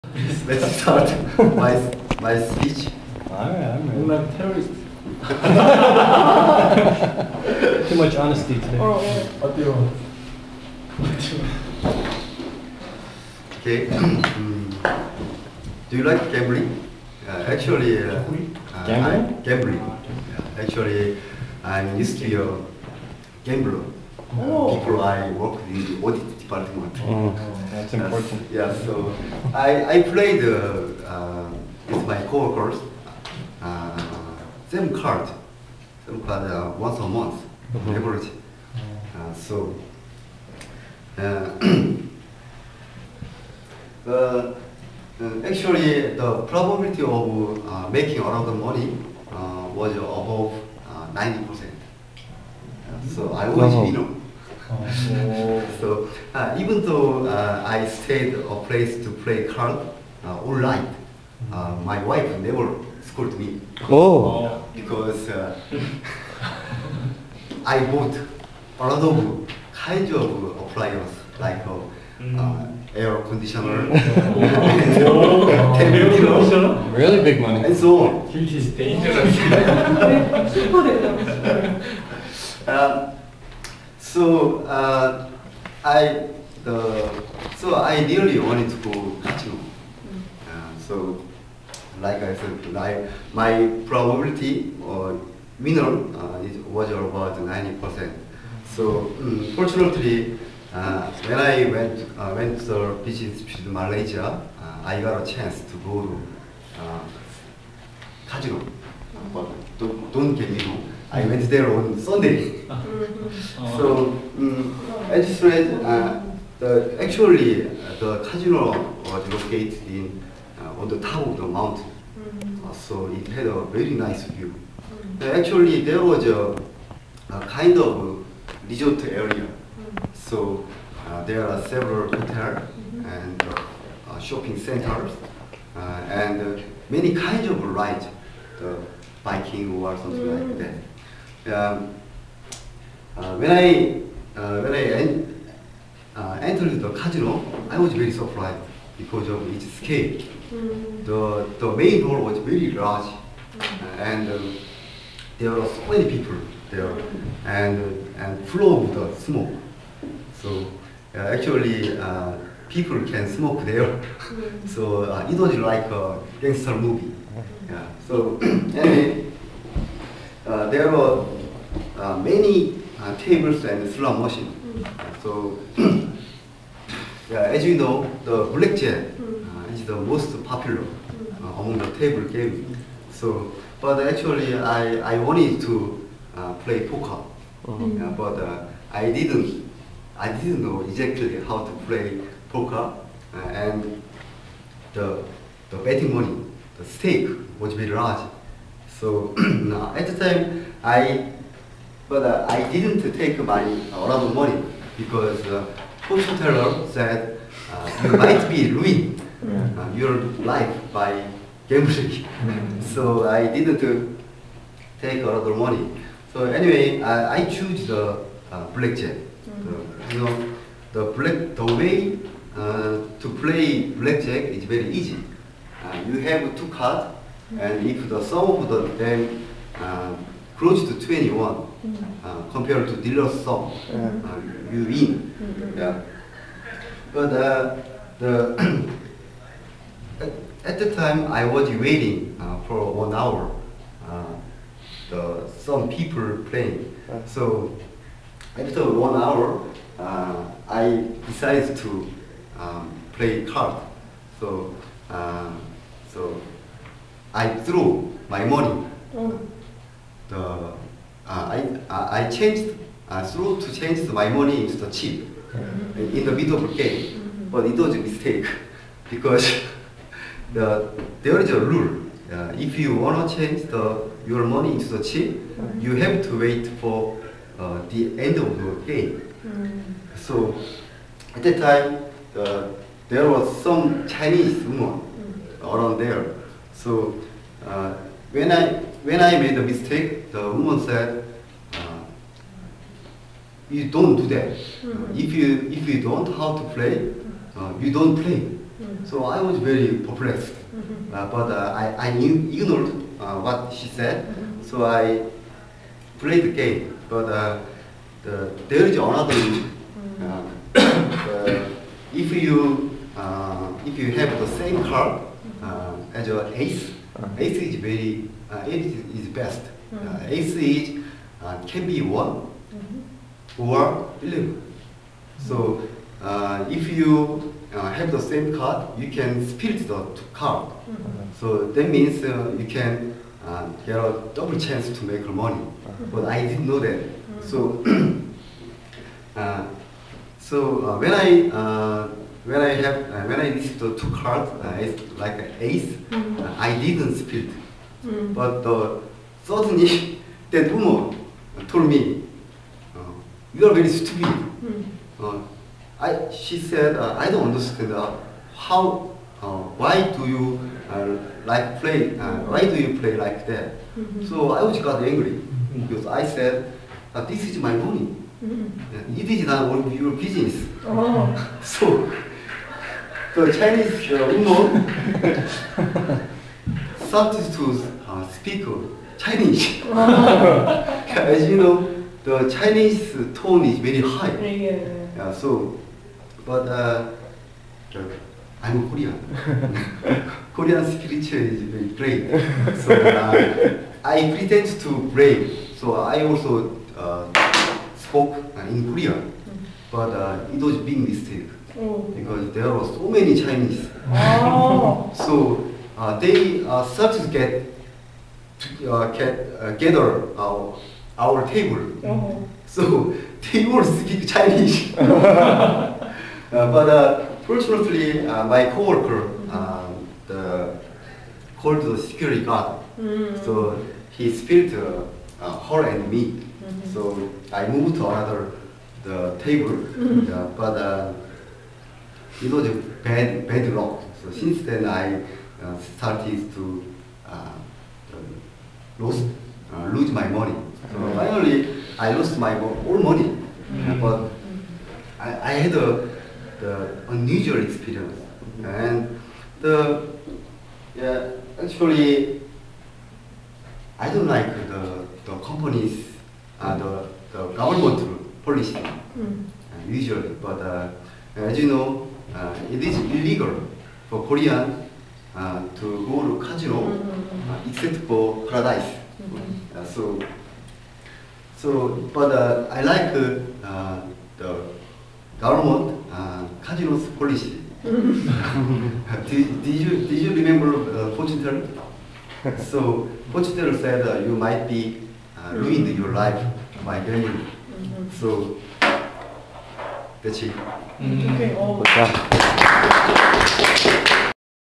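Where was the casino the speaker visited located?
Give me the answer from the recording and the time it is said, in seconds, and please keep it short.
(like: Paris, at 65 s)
top of the mountain, at 120 s.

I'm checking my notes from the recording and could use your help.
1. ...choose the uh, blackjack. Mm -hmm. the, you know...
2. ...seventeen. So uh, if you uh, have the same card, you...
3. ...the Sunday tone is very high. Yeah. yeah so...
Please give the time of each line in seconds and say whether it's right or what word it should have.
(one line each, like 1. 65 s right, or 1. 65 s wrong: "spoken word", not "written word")
1. 217 s right
2. 324 s wrong: "eleven", not "seventeen"
3. 382 s wrong: "Chinese", not "Sunday".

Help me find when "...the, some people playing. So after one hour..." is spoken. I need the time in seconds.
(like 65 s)
245 s.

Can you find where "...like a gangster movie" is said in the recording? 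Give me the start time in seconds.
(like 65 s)
165 s.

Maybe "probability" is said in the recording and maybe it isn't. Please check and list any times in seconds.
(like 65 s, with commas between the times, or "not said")
46 s, 93 s.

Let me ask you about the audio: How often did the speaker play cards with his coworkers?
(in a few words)
once a month.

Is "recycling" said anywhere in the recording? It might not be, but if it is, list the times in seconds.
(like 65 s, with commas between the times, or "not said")
not said.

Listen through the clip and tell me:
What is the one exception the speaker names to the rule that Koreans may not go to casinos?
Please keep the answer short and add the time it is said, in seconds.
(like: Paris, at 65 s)
Paradise, at 468 s.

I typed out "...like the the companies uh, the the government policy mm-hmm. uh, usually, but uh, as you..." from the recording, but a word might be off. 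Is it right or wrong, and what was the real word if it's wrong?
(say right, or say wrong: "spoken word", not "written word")
right.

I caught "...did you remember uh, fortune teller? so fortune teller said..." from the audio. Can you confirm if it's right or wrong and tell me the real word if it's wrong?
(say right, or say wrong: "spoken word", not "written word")
right.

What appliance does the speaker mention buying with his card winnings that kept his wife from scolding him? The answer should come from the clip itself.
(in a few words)
air conditioner.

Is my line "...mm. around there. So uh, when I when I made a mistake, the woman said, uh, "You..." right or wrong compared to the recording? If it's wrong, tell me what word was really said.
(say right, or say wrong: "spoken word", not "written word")
right.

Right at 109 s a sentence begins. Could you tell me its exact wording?
But don't, don't get me wrong.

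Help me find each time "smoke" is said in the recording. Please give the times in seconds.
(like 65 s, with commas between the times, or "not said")
159 s, 163 s.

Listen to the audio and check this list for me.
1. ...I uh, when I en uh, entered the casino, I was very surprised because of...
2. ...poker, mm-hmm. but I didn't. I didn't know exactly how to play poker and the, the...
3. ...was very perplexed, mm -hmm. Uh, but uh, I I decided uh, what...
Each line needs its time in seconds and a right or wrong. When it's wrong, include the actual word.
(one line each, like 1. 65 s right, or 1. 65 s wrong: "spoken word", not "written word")
1. 143 s right
2. 186 s right
3. 299 s wrong: "ignored", not "decided".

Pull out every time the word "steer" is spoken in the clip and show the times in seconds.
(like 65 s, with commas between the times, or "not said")
not said.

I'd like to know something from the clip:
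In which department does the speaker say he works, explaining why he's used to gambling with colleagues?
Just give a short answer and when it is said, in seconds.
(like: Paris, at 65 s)
audit department, at 26 s.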